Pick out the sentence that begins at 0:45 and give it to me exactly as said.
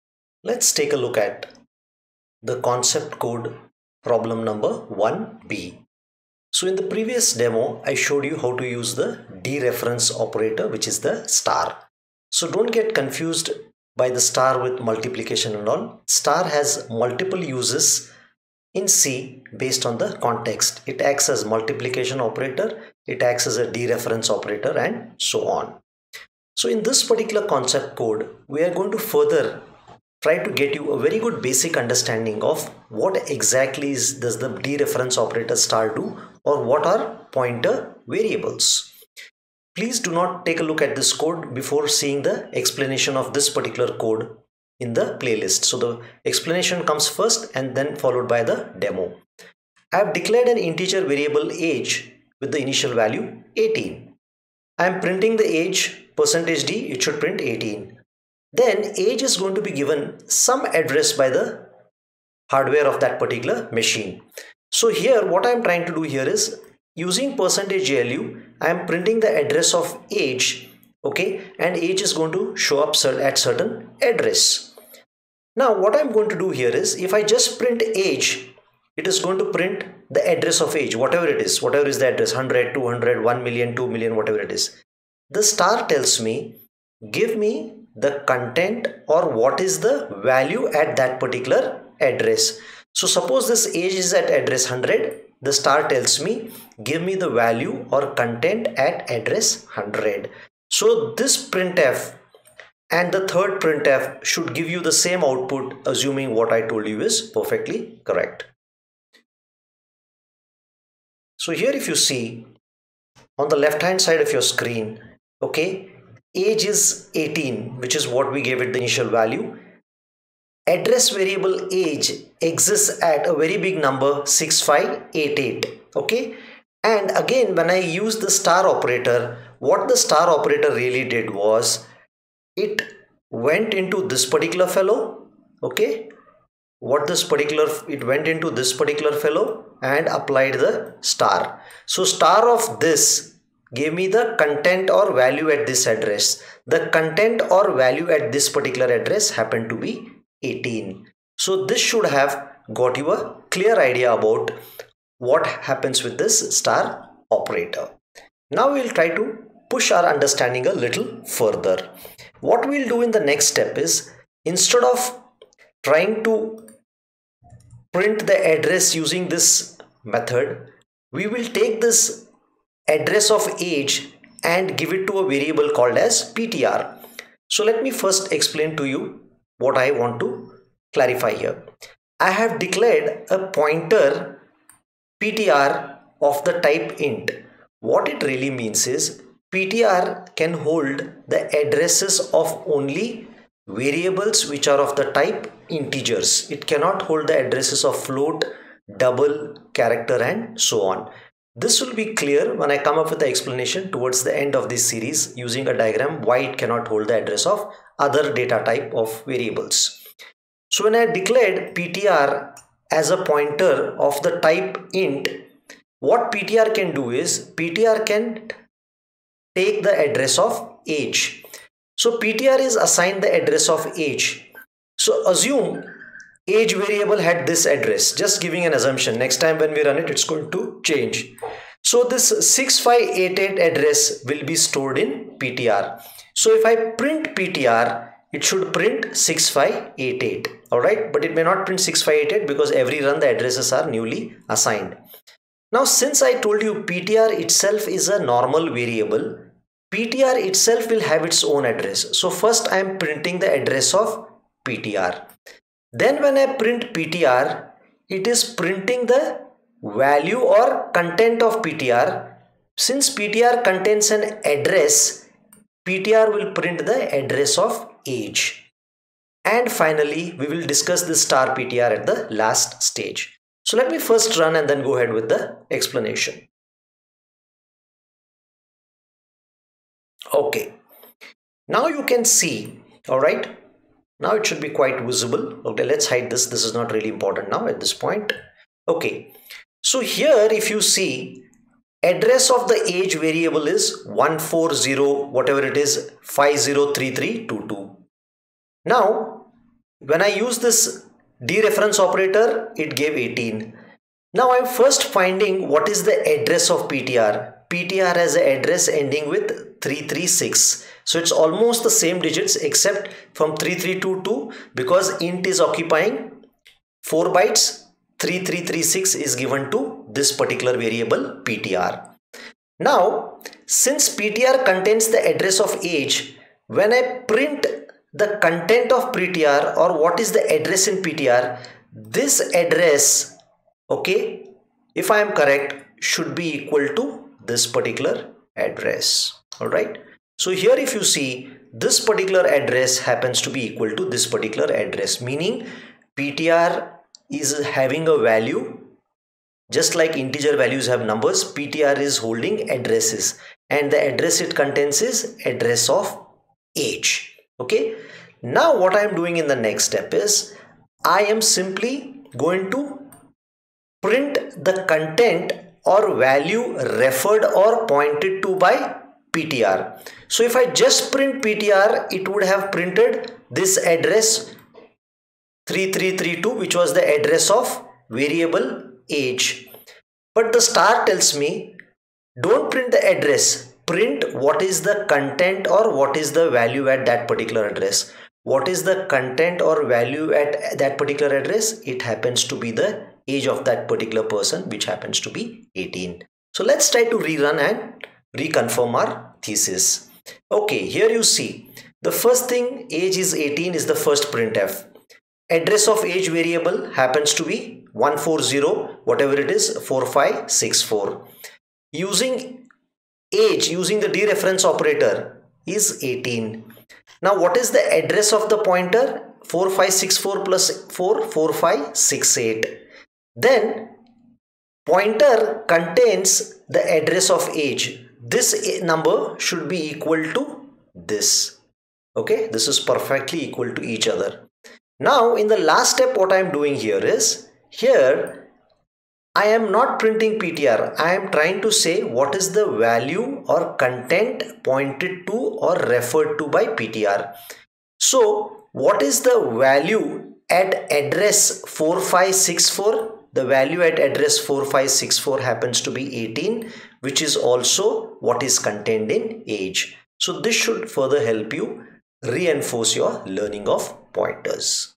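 So the explanation comes first and then followed by the demo.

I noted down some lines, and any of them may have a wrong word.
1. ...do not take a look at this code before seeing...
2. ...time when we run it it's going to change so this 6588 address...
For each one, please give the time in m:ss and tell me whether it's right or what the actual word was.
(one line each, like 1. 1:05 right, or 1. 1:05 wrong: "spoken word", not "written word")
1. 0:39 right
2. 3:49 right.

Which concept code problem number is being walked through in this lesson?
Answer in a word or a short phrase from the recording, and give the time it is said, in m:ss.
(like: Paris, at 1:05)
1b, at 0:04.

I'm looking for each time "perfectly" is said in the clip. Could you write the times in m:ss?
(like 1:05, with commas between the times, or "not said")
1:47, 7:12.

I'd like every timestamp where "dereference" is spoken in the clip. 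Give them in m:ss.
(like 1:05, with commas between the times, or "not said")
0:09, 0:23, 0:34, 5:01, 6:54.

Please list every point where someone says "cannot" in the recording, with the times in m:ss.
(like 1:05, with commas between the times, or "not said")
3:16, 3:26.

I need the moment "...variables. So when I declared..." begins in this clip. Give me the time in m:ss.
3:29.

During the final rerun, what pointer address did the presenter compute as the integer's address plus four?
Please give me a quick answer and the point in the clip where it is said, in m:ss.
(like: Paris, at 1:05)
4568, at 7:01.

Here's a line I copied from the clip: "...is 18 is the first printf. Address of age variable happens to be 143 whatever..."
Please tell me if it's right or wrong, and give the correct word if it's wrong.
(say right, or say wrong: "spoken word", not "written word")
wrong: "140", not "143".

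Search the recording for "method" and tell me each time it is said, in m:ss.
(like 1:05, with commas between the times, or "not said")
2:50.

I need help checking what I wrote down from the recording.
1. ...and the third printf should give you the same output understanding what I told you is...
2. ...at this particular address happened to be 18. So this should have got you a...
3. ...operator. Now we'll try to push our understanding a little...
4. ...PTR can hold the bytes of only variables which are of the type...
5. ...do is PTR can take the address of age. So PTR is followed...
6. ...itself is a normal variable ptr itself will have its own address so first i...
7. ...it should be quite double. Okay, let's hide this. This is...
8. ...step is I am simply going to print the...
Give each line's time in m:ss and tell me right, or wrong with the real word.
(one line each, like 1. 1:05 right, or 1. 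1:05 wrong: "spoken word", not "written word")
1. 1:42 wrong: "assuming", not "understanding"
2. 2:28 right
3. 2:37 right
4. 3:09 wrong: "addresses", not "bytes"
5. 3:36 wrong: "assigned", not "followed"
6. 4:07 right
7. 4:44 wrong: "visible", not "double"
8. 5:59 right.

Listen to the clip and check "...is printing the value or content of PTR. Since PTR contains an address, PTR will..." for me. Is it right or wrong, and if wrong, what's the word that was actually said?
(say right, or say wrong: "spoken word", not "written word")
right.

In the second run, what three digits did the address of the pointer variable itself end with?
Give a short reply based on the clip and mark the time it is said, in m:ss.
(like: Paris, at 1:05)
336, at 5:09.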